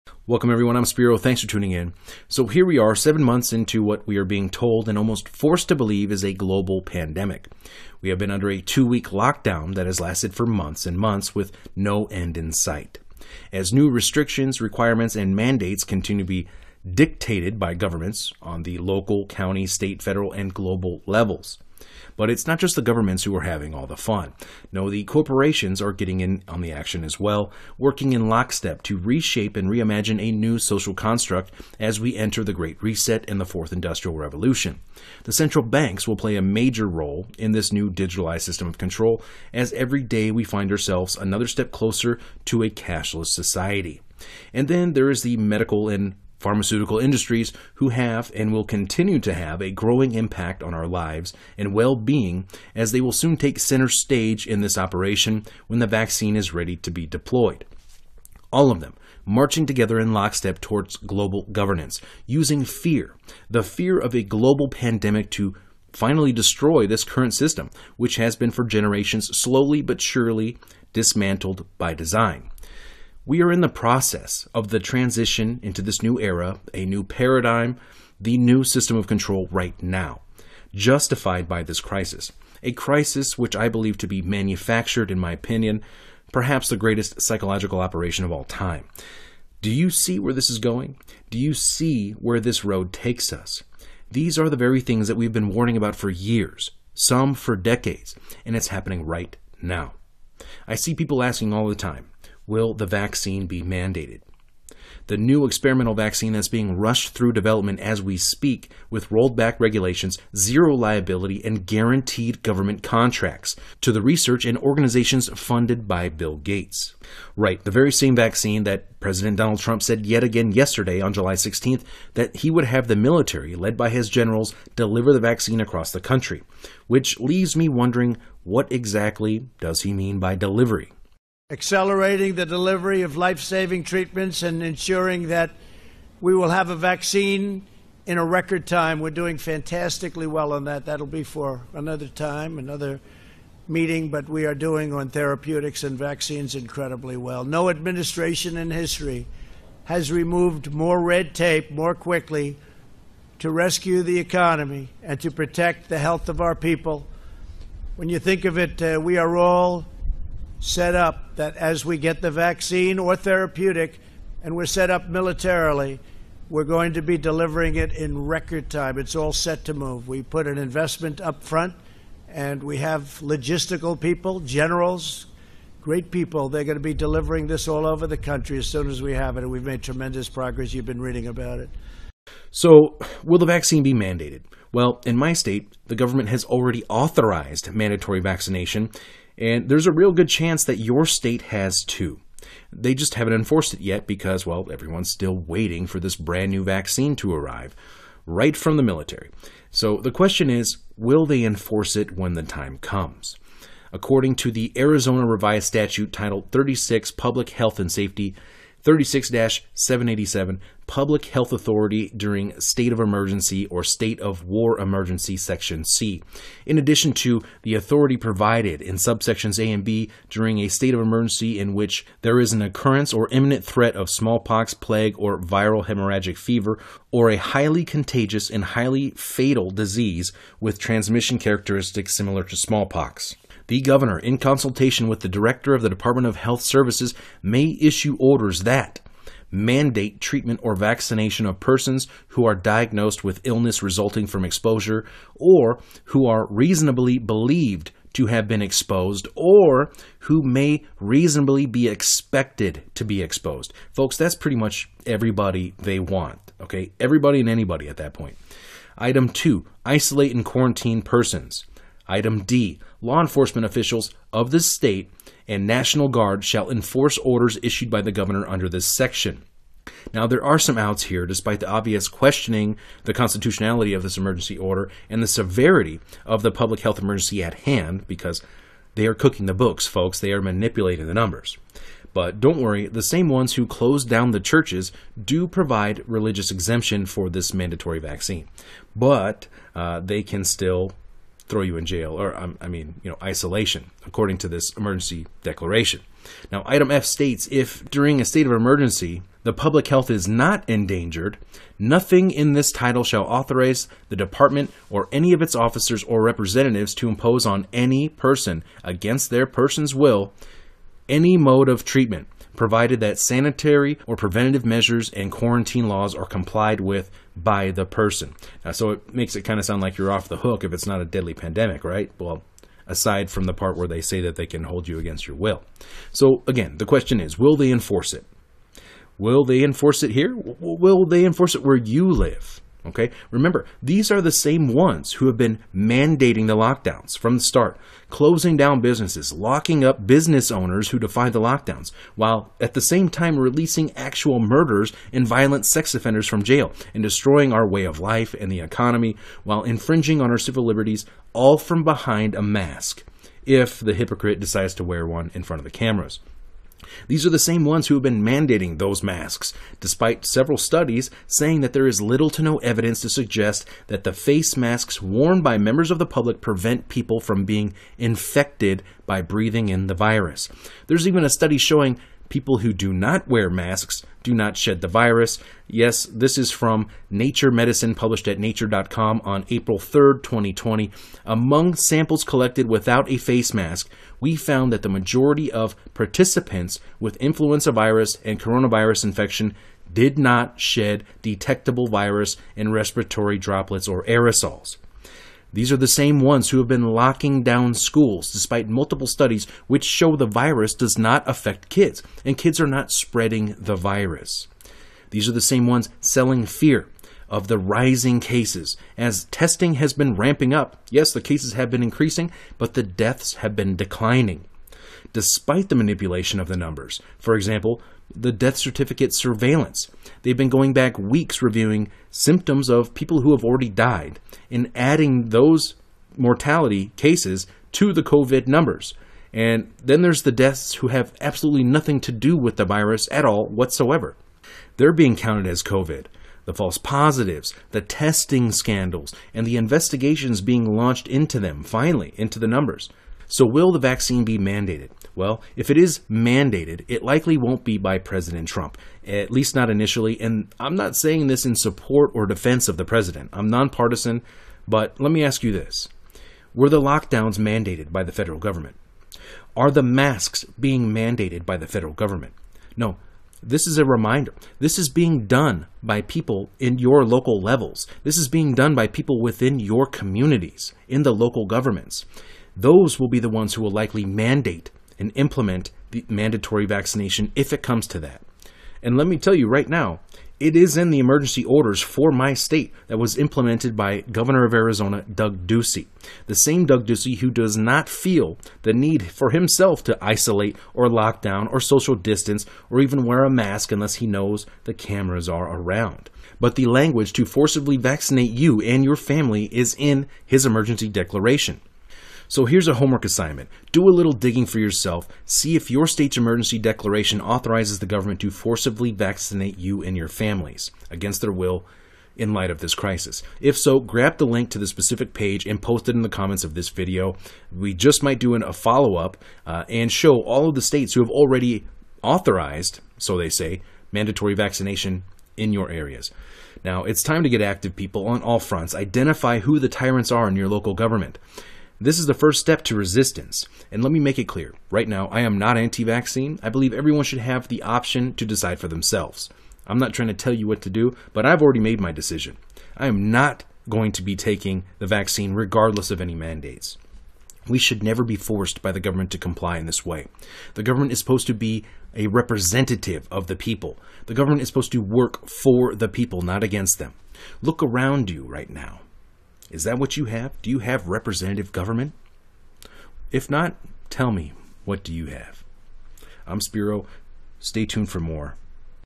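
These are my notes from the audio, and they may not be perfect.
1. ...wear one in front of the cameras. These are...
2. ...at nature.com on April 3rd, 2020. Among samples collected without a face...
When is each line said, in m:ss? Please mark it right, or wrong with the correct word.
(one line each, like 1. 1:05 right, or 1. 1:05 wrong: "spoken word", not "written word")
1. 5:54 right
2. 6:18 right.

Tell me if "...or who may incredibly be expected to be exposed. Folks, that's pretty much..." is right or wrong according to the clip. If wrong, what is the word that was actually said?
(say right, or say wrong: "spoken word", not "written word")
wrong: "reasonably", not "incredibly".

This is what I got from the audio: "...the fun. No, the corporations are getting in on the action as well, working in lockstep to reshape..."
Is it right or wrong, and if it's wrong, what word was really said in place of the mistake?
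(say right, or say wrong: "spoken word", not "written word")
right.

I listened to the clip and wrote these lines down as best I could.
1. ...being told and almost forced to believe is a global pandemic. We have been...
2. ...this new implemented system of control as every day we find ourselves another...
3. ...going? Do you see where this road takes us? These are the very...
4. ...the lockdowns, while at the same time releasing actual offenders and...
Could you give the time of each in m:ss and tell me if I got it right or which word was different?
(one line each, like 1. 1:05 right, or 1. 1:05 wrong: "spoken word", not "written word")
1. 0:04 right
2. 0:37 wrong: "digitalized", not "implemented"
3. 1:30 right
4. 5:41 wrong: "murderers", not "offenders".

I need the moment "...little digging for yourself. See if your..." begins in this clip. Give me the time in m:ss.
8:23.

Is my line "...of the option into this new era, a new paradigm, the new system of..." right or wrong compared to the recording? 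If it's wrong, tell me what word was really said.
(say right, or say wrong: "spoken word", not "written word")
wrong: "transition", not "option".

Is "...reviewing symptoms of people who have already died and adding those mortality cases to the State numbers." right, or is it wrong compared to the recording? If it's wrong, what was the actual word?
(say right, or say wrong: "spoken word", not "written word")
wrong: "COVID", not "State".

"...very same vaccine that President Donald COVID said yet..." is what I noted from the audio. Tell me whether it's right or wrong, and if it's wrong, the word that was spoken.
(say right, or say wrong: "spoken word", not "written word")
wrong: "Trump", not "COVID".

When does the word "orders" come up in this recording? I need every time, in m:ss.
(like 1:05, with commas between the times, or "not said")
3:58, 4:27, 4:34, 8:01.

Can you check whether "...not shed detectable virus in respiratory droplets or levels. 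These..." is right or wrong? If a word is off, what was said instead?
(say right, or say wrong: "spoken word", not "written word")
wrong: "aerosols", not "levels".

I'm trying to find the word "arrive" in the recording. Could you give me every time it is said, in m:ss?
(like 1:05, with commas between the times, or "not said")
3:17.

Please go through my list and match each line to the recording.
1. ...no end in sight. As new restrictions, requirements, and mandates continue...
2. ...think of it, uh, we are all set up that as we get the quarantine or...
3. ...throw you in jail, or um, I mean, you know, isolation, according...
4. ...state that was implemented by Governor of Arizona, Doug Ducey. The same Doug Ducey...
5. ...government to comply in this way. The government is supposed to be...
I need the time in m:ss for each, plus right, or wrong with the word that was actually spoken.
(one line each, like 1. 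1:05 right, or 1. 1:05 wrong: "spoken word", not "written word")
1. 0:11 right
2. 2:38 wrong: "vaccine", not "quarantine"
3. 4:51 right
4. 8:02 right
5. 9:08 right.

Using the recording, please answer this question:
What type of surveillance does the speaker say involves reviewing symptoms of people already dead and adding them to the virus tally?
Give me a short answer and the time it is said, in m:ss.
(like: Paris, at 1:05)
death certificate surveillance, at 6:58.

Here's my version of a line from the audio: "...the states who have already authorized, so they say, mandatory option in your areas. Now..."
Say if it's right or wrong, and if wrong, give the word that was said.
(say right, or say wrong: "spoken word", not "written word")
wrong: "vaccination", not "option".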